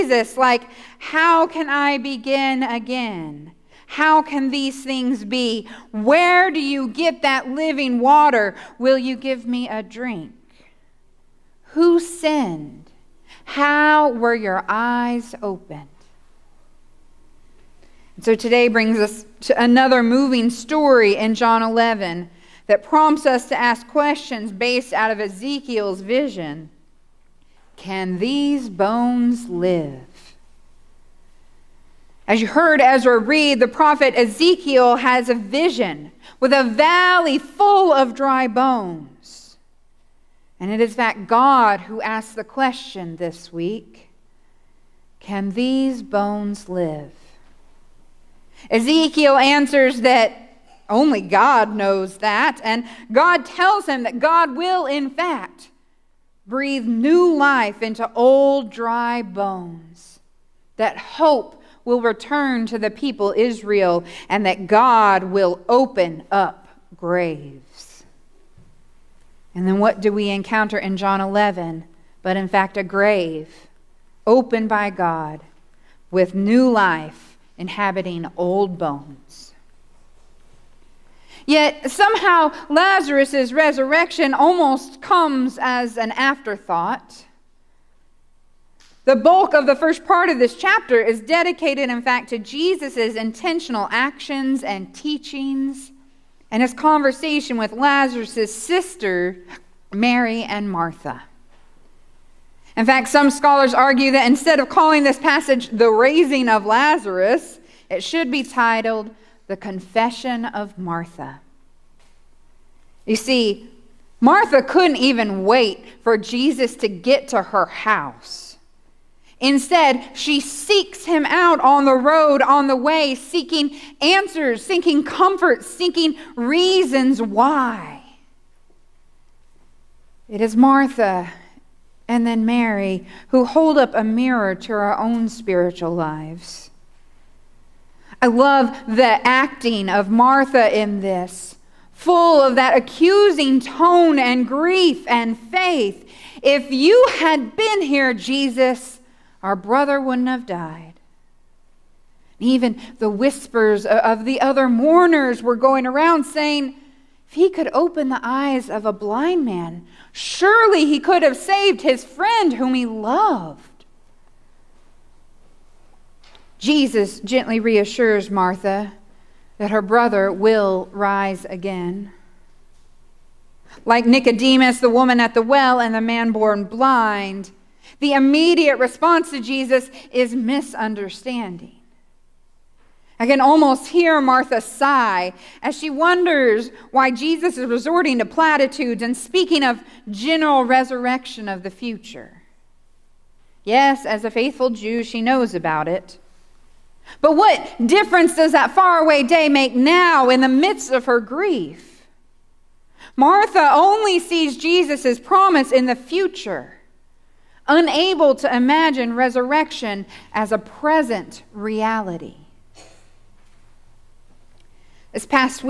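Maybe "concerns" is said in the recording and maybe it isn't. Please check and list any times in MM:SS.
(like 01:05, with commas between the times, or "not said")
not said.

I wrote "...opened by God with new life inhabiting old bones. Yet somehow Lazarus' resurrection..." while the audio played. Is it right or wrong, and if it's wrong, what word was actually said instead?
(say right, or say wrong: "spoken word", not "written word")
right.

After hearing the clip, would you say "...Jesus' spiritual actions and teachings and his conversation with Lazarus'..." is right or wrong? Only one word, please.
wrong.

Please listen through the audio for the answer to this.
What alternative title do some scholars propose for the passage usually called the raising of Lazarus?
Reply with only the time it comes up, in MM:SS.
01:49.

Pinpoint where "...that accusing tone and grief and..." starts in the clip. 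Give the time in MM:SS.
02:22.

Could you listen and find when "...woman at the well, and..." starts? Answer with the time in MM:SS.
02:54.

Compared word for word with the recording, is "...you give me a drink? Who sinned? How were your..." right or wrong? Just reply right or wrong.
right.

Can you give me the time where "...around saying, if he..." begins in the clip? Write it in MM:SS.
02:35.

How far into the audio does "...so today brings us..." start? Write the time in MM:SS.
00:18.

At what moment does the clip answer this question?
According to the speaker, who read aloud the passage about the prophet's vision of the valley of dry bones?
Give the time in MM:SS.
00:32.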